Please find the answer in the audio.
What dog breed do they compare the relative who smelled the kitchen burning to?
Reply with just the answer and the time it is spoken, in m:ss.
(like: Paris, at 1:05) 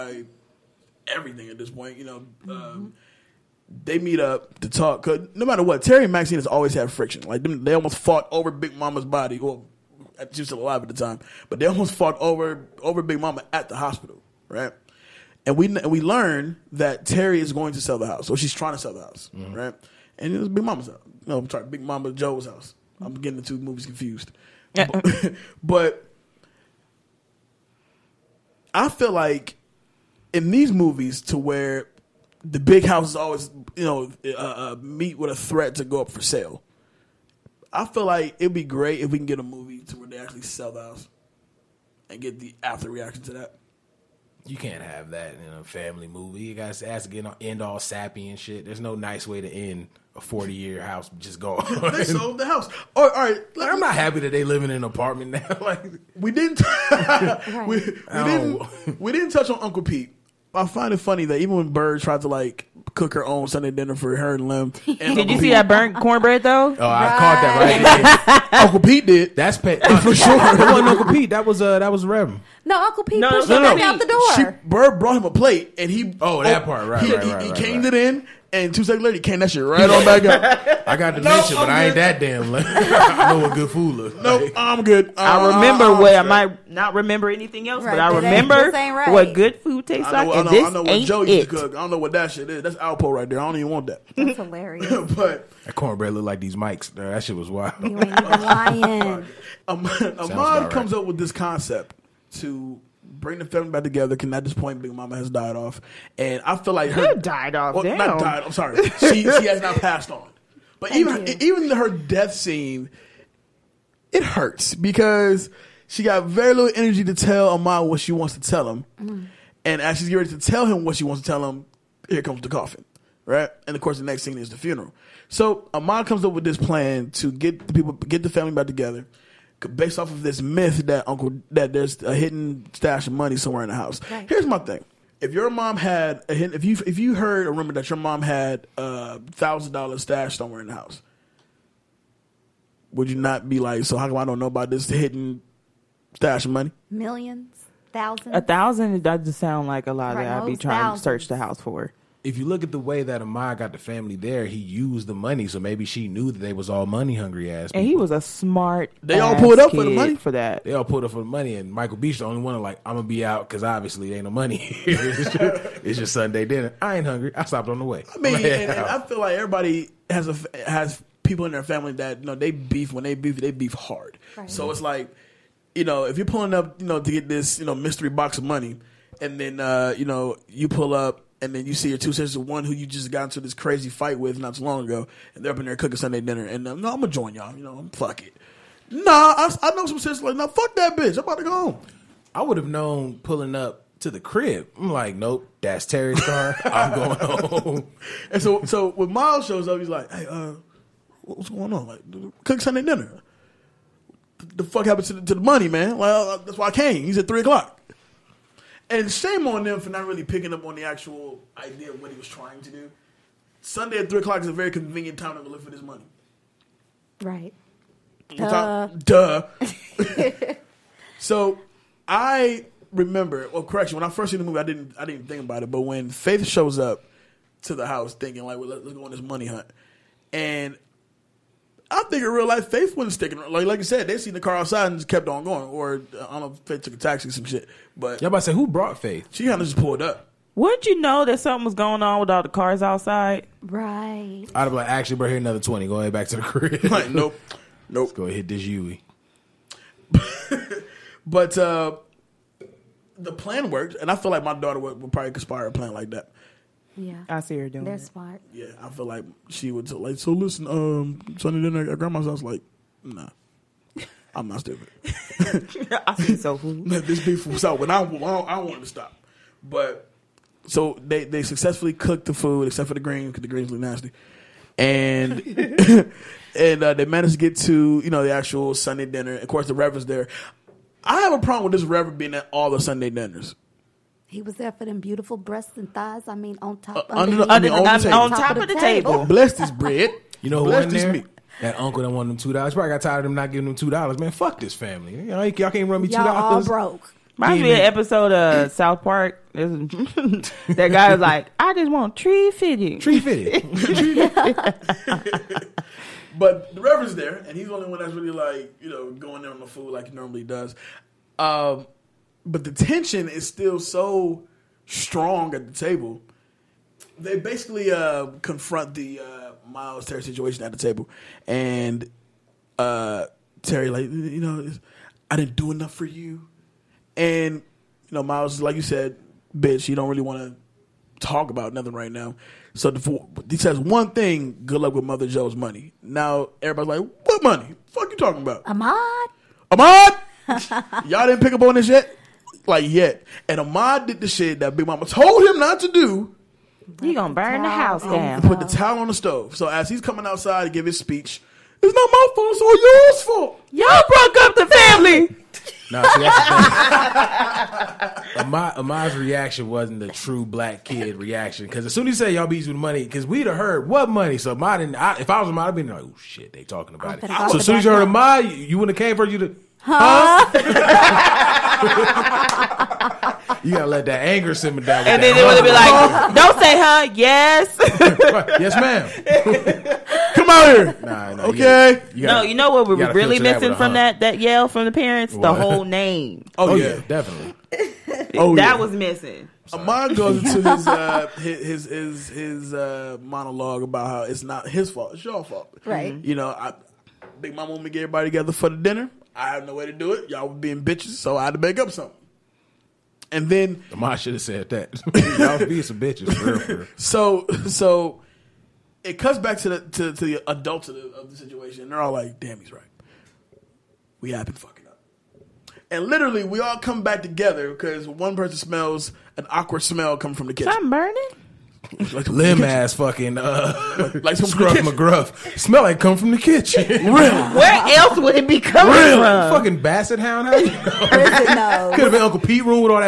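basset hound, at 7:09.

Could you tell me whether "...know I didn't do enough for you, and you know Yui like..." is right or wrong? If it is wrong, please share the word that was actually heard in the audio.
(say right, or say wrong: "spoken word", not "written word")
wrong: "Miles", not "Yui".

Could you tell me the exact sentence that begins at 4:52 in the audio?
Probably got tired of him not giving them two dollars.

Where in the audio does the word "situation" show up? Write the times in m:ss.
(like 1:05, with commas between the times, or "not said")
5:20, 6:51.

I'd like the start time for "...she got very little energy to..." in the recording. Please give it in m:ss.
1:55.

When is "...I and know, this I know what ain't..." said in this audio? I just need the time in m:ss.
1:30.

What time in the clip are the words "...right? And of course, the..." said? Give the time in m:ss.
2:03.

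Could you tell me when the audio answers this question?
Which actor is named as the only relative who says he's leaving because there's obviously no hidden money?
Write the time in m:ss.
2:41.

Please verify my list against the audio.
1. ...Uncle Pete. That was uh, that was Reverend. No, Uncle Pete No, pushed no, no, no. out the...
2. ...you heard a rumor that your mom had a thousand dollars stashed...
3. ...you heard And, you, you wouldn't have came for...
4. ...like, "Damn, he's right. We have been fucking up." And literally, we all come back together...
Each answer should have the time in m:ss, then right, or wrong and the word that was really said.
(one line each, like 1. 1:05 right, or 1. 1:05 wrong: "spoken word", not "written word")
1. 1:10 right
2. 2:16 right
3. 6:07 wrong: "Ahmad", not "And"
4. 6:52 right.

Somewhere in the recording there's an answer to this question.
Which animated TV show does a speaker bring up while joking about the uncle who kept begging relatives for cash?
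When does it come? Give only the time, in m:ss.
4:58.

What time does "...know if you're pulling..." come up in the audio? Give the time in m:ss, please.
2:55.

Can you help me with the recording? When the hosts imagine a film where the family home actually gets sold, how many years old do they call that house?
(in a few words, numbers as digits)
40.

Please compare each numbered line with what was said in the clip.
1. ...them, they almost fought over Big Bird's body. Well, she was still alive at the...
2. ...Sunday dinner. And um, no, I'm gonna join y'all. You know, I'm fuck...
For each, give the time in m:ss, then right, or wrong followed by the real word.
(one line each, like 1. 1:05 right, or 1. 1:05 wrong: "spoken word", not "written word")
1. 0:07 wrong: "Mama", not "Bird"
2. 3:05 right.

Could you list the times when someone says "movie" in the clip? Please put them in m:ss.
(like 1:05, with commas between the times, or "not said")
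0:23, 0:30, 0:39, 0:46, 3:44.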